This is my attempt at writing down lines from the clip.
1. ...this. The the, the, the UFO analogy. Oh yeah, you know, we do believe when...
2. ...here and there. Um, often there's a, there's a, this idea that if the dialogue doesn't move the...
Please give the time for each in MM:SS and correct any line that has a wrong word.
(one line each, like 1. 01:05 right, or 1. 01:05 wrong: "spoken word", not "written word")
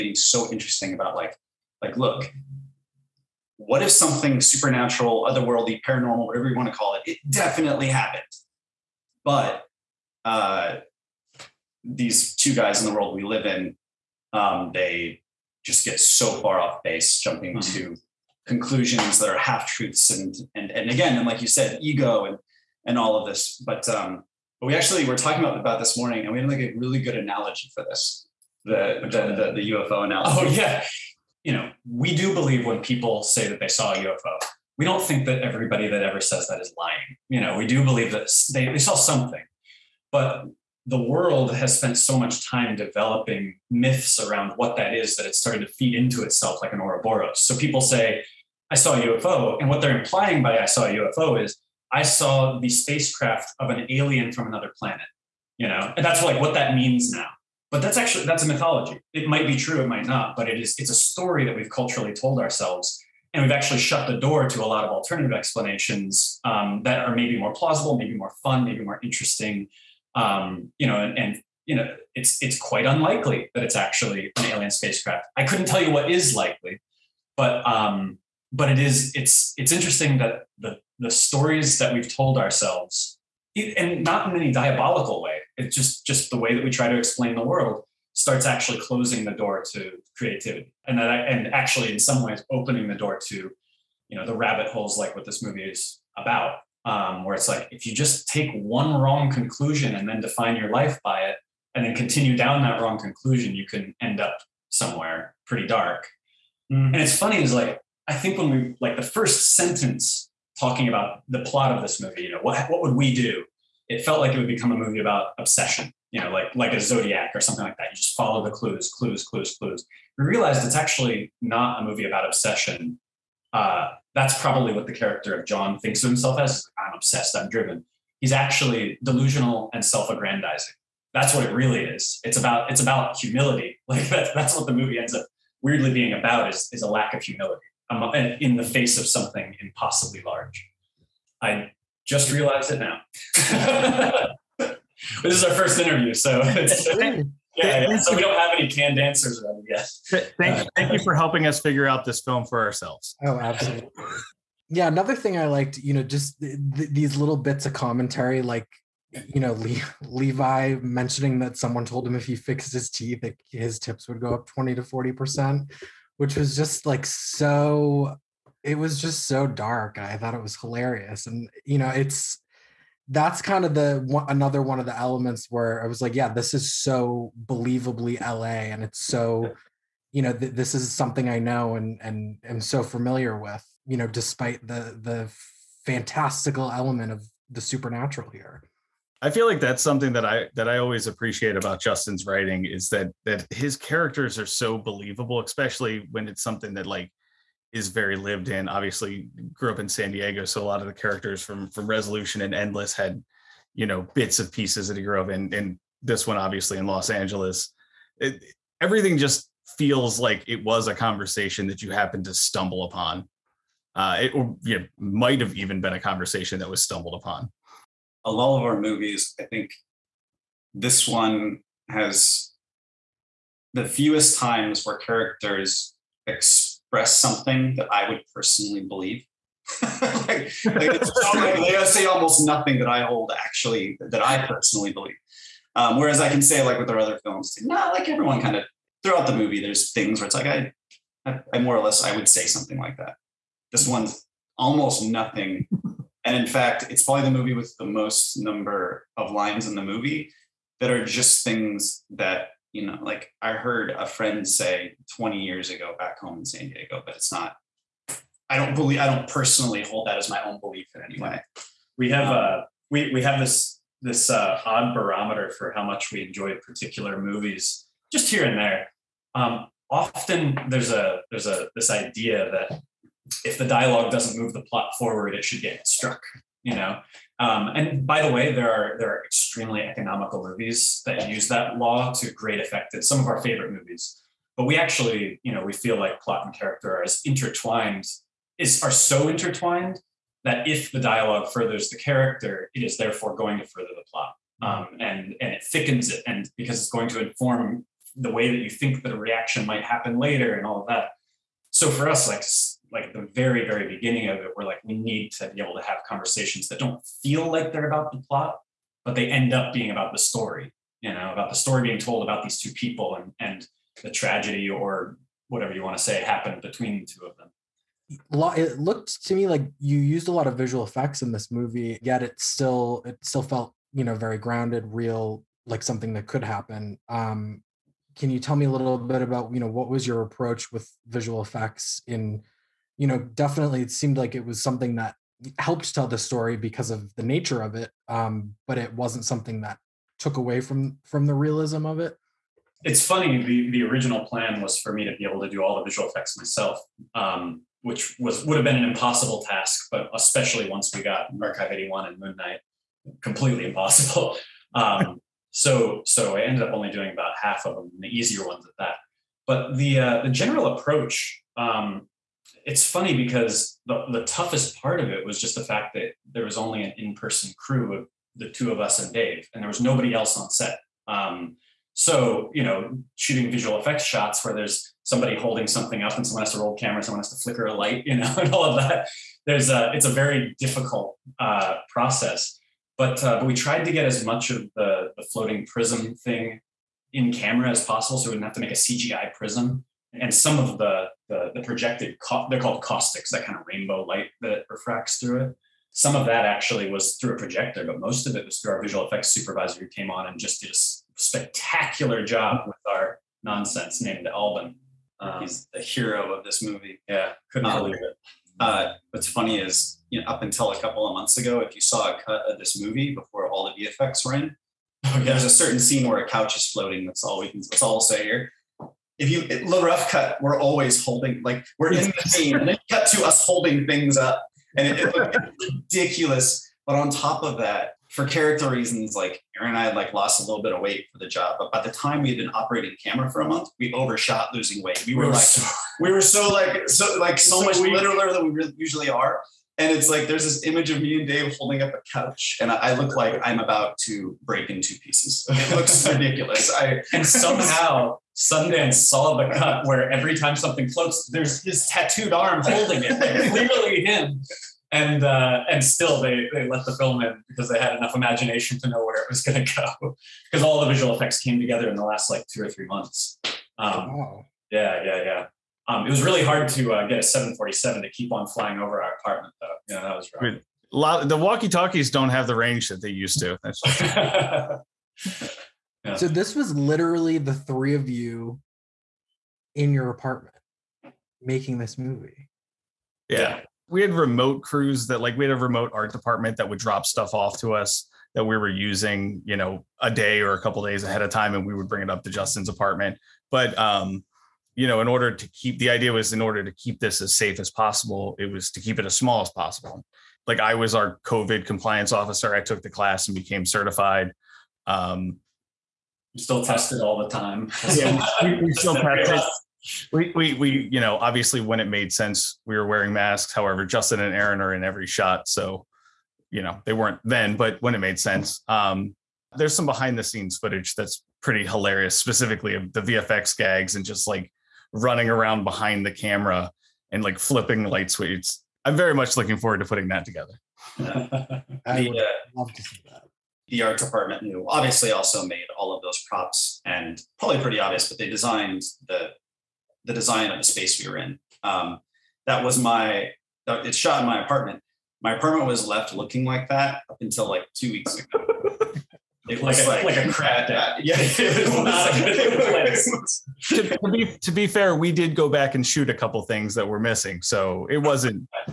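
1. 00:27 right
2. 04:28 right.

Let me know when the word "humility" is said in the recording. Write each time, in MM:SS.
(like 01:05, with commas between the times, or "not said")
02:13, 02:17.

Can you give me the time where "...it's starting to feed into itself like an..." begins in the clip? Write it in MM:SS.
00:45.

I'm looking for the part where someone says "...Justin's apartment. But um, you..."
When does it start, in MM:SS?
08:12.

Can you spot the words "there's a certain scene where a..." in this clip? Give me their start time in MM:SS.
06:55.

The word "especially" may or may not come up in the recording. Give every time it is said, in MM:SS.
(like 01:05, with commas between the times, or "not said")
03:15, 05:50.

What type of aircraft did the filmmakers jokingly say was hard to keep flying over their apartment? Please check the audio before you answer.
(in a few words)
747.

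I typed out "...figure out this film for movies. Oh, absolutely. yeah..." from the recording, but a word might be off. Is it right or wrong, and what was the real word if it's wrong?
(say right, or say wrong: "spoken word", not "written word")
wrong: "ourselves", not "movies".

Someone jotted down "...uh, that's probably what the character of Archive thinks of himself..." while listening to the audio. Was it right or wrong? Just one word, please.
wrong.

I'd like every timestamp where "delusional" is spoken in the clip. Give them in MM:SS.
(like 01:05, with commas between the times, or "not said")
02:09.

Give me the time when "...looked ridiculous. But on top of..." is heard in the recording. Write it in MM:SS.
07:05.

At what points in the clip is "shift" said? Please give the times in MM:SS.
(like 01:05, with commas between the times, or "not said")
not said.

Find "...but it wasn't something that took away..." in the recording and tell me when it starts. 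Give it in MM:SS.
05:38.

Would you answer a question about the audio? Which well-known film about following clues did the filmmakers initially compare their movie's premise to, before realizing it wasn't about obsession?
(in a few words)
Zodiac.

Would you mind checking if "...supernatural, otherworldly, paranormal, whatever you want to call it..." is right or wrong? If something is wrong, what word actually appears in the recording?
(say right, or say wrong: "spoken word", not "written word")
right.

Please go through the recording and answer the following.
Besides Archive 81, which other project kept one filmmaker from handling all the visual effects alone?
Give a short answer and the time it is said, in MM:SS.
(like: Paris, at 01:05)
Moon Knight, at 05:52.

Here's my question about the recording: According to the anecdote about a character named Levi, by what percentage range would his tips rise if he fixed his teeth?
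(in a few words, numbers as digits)
20 to 40 percent.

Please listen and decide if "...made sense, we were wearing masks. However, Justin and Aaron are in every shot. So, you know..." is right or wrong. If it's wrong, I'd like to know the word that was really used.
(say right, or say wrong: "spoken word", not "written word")
right.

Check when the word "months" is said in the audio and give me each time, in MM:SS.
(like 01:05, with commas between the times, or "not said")
06:51, 07:13, 07:42.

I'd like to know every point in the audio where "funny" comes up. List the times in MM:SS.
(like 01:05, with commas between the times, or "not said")
01:47, 05:43, 06:02, 06:49.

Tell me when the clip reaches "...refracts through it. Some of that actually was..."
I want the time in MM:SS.
06:34.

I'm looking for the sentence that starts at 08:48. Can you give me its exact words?
I'm very much looking forward to putting that together.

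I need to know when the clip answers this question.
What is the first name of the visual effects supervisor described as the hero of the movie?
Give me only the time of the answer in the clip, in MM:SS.
06:44.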